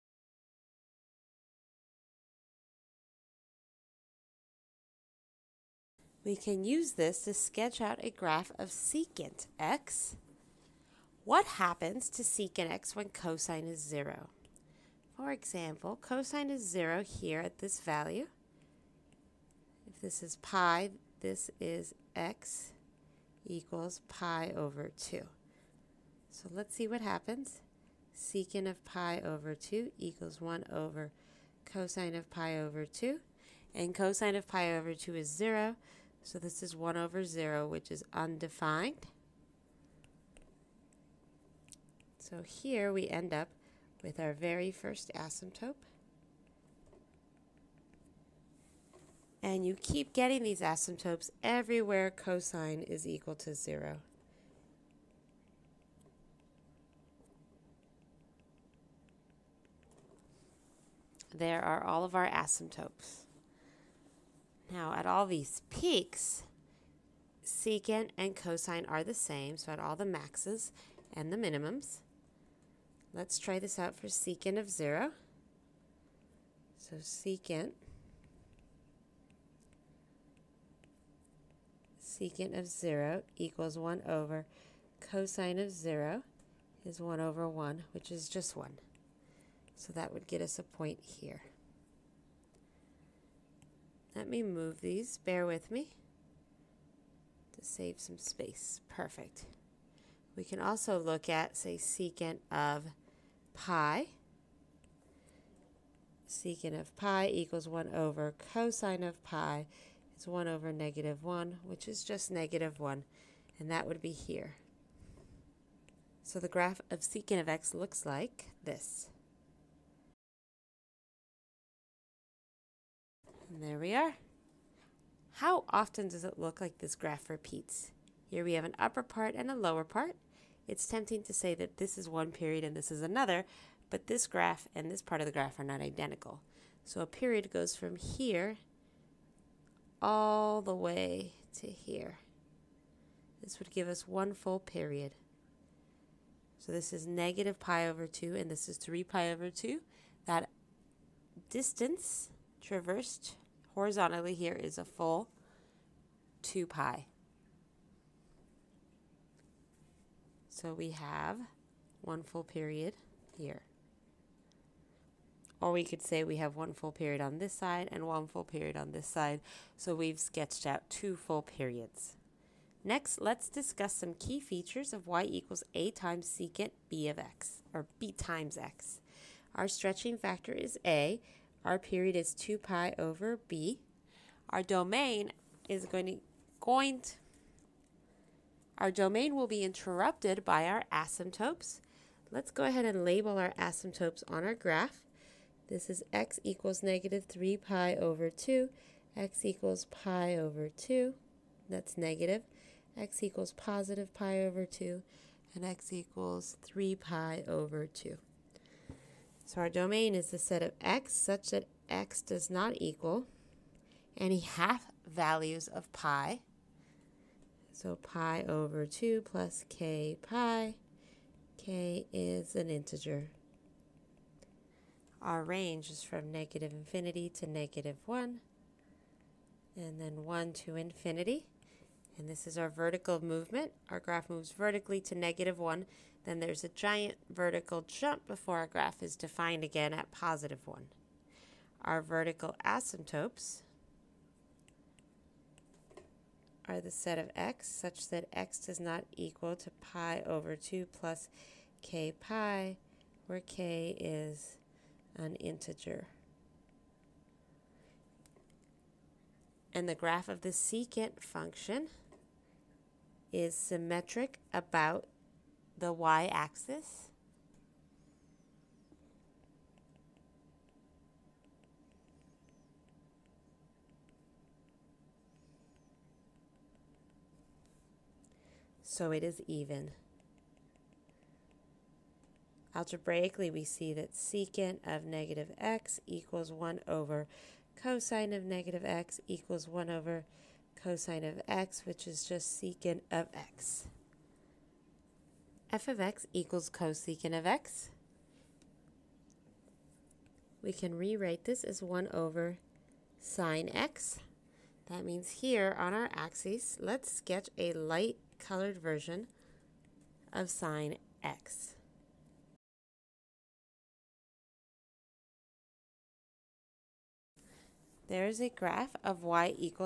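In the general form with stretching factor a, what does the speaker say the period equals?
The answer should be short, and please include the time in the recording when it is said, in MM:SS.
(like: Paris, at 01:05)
2 pi over b, at 03:02.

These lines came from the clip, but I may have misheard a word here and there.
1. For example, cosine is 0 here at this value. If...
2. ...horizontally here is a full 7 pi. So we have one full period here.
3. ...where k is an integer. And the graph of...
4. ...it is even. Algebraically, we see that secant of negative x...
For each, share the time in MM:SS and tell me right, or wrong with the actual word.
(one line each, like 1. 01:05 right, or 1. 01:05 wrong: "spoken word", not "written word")
1. 00:15 right
2. 02:33 wrong: "2", not "7"
3. 04:13 right
4. 04:39 right.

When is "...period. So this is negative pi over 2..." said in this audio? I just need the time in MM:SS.
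02:24.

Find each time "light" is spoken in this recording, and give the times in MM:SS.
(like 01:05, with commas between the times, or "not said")
05:07.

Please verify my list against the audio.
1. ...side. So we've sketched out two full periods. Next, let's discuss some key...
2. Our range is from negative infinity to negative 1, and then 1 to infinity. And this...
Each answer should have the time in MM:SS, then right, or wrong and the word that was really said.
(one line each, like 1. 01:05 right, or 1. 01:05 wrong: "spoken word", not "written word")
1. 02:49 right
2. 03:45 right.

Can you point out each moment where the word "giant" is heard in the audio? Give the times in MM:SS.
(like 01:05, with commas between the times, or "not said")
03:56.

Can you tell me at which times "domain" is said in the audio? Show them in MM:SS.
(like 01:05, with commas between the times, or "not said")
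03:04, 03:08, 03:29.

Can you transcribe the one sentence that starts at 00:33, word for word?
And cosine of pi over 2 is 0, so this is 1 over 0, which is undefined.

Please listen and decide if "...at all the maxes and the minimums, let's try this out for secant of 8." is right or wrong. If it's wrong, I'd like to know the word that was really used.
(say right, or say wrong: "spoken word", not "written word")
wrong: "0", not "8".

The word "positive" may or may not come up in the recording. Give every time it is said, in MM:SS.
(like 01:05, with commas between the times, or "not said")
03:23, 04:00.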